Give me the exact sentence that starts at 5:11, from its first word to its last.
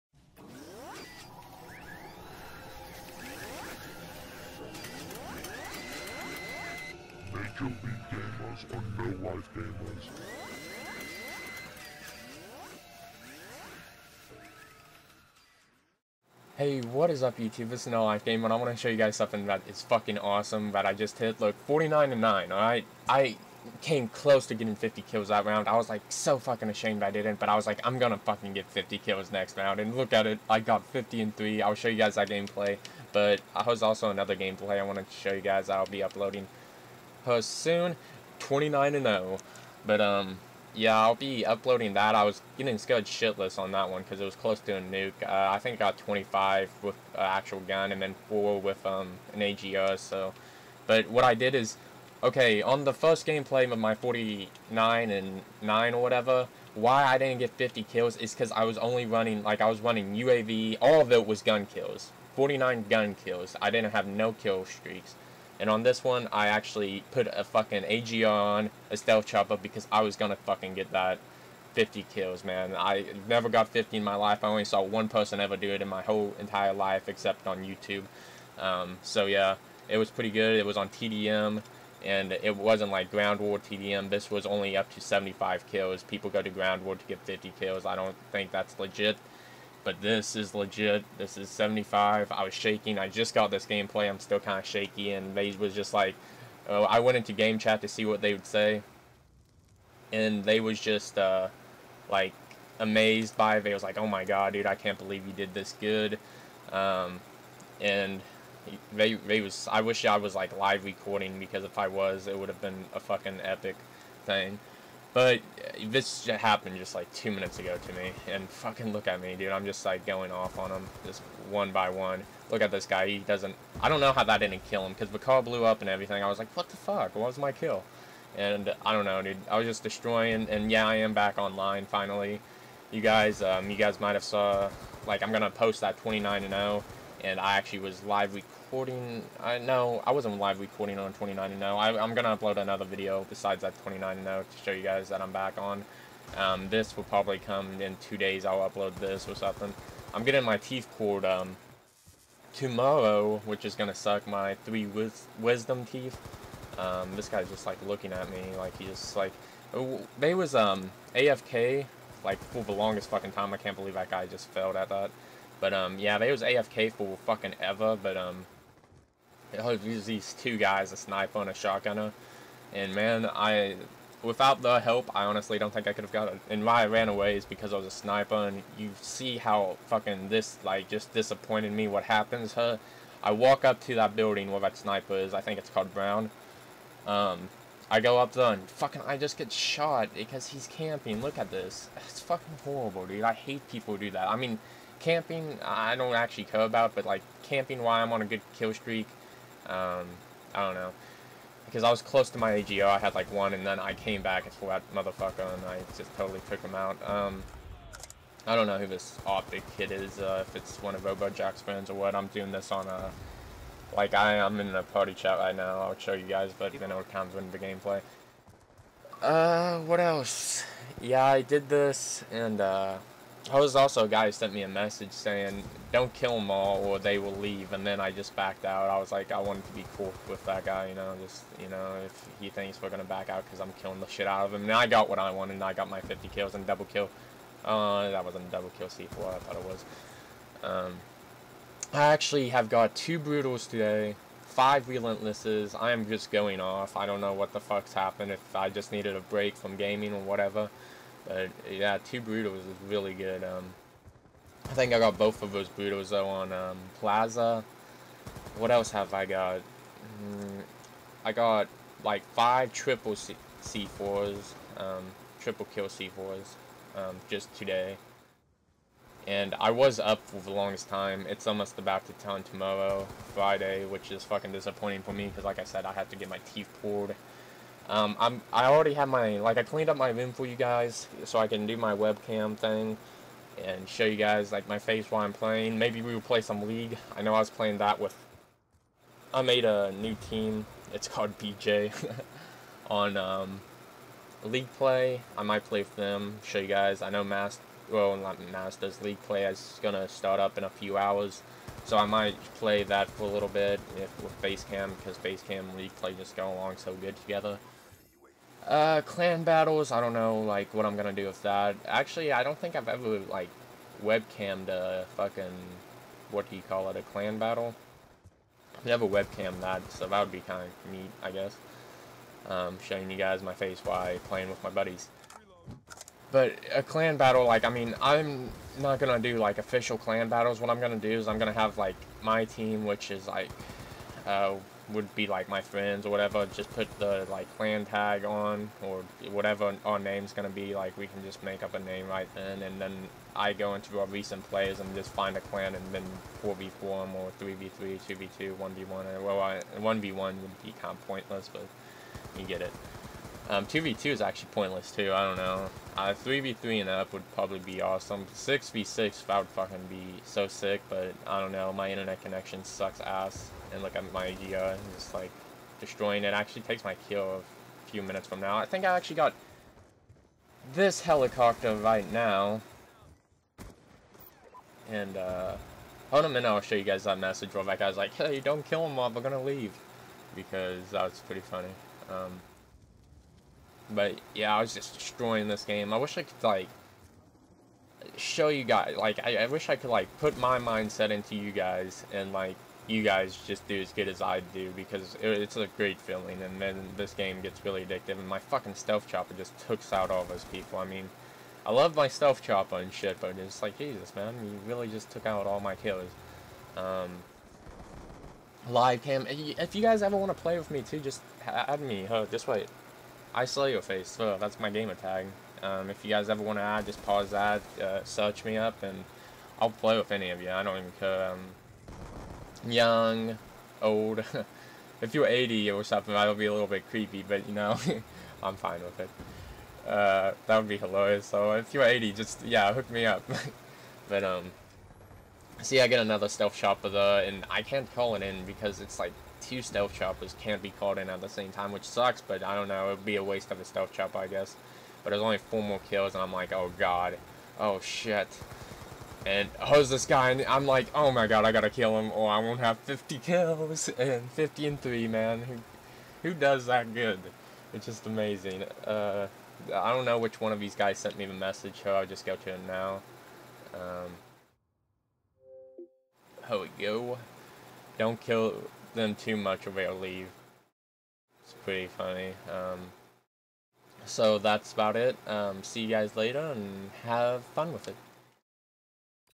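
Actually, I don't think I've ever, like, webcammed a fucking, what do you call it, a clan battle?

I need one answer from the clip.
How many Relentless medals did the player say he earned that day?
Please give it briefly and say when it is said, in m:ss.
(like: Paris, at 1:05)
5, at 4:04.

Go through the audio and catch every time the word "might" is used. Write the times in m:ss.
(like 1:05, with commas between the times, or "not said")
2:13, 4:55, 5:02.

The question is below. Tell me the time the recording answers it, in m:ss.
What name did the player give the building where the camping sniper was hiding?
3:05.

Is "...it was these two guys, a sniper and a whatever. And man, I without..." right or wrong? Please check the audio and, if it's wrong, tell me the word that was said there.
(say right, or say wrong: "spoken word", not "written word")
wrong: "shotgunner", not "whatever".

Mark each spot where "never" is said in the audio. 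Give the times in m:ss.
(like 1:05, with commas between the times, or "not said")
1:13, 5:18.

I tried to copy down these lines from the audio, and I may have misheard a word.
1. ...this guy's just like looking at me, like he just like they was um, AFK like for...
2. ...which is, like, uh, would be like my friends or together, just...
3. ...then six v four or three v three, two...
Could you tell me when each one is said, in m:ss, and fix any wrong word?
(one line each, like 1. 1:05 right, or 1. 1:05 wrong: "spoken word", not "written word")
1. 2:37 right
2. 5:32 wrong: "whatever", not "together"
3. 5:45 wrong: "four", not "six".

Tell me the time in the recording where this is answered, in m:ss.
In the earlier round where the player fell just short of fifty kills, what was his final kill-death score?
0:21.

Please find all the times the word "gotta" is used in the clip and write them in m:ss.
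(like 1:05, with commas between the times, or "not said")
7:31.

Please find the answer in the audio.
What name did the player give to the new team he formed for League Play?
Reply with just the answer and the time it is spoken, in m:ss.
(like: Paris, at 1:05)
BJ, at 4:51.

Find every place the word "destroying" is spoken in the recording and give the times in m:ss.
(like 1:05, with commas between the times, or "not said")
2:09, 6:05, 6:24.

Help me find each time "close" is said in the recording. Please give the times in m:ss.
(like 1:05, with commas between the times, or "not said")
0:24, 0:44, 3:22.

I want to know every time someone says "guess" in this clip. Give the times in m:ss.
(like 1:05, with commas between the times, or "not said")
5:21, 7:24.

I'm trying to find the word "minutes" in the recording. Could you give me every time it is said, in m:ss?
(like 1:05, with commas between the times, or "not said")
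1:57, 6:08, 6:16.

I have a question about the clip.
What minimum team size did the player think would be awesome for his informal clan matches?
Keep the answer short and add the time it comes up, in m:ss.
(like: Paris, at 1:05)
3v3, at 5:56.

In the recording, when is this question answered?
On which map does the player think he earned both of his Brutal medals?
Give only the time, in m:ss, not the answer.
4:16.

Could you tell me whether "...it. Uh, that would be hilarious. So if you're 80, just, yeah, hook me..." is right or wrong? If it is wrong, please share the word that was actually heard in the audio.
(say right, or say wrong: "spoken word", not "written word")
right.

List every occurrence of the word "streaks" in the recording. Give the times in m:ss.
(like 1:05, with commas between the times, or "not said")
1:04, 3:18.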